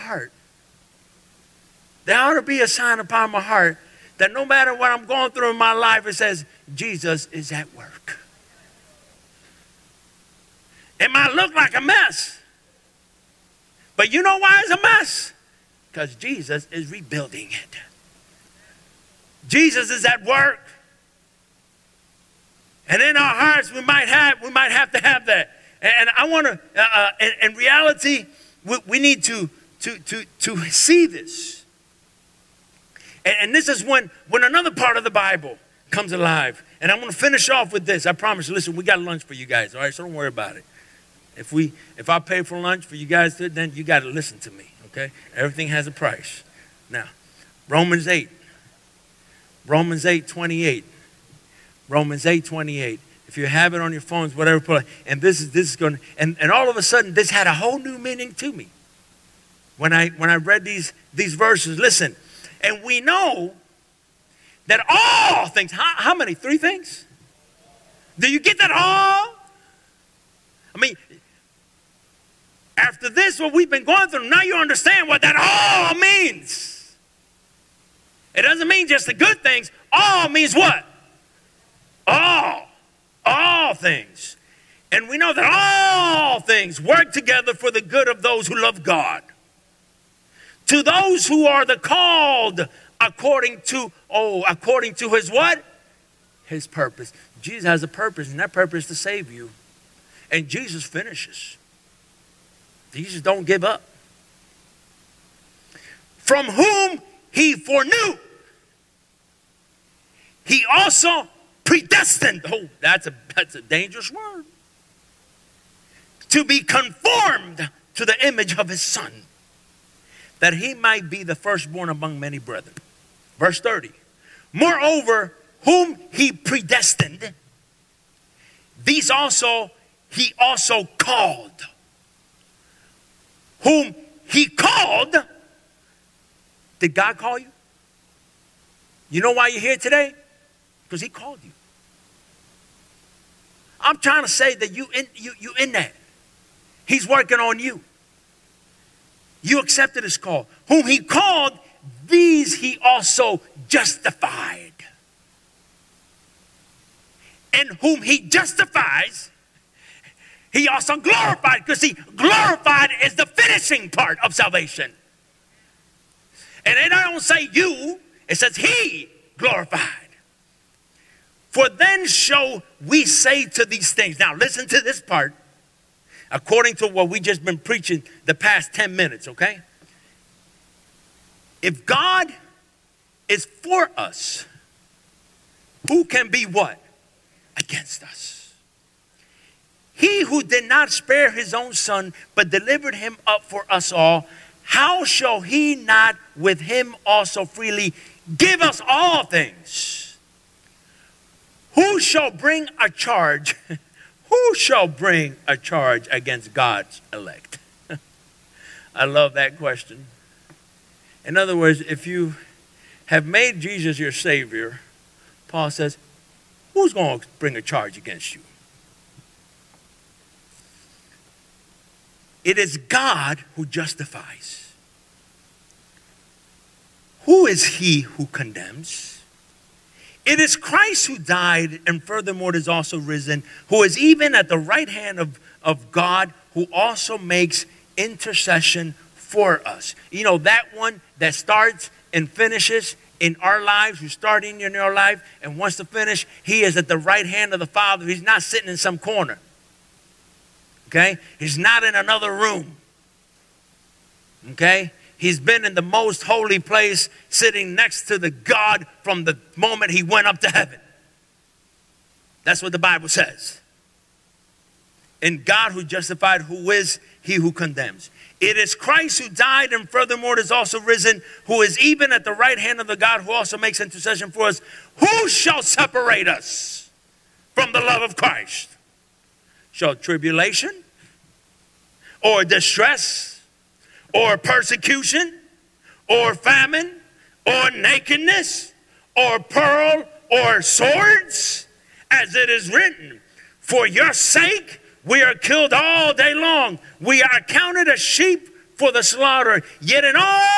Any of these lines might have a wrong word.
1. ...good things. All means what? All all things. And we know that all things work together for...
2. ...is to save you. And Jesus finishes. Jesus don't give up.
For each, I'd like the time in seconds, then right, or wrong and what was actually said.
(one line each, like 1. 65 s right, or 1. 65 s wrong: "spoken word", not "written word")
1. 79 s right
2. 98 s right.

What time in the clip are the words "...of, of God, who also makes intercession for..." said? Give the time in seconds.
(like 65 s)
235 s.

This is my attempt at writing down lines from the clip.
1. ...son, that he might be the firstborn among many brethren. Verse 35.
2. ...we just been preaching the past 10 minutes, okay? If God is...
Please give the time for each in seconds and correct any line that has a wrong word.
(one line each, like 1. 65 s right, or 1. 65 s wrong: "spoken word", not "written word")
1. 118 s wrong: "30", not "35"
2. 177 s right.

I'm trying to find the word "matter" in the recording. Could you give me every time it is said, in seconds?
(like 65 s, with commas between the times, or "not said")
4 s.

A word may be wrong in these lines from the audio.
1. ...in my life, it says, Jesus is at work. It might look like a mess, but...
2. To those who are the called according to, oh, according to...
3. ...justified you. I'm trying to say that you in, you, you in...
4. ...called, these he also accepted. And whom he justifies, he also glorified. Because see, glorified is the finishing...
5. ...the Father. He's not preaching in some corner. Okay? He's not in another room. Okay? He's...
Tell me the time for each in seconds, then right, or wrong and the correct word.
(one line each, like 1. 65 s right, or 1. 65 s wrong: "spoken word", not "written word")
1. 5 s right
2. 90 s right
3. 141 s wrong: "called", not "justified"
4. 150 s wrong: "justified", not "accepted"
5. 247 s wrong: "sitting", not "preaching".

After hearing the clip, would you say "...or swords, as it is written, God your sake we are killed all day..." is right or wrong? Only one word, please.
wrong.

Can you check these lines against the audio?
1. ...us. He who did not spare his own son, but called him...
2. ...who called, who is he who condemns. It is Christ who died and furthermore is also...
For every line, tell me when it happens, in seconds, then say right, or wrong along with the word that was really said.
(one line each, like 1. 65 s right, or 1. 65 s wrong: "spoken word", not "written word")
1. 188 s wrong: "delivered", not "called"
2. 265 s wrong: "justified", not "called".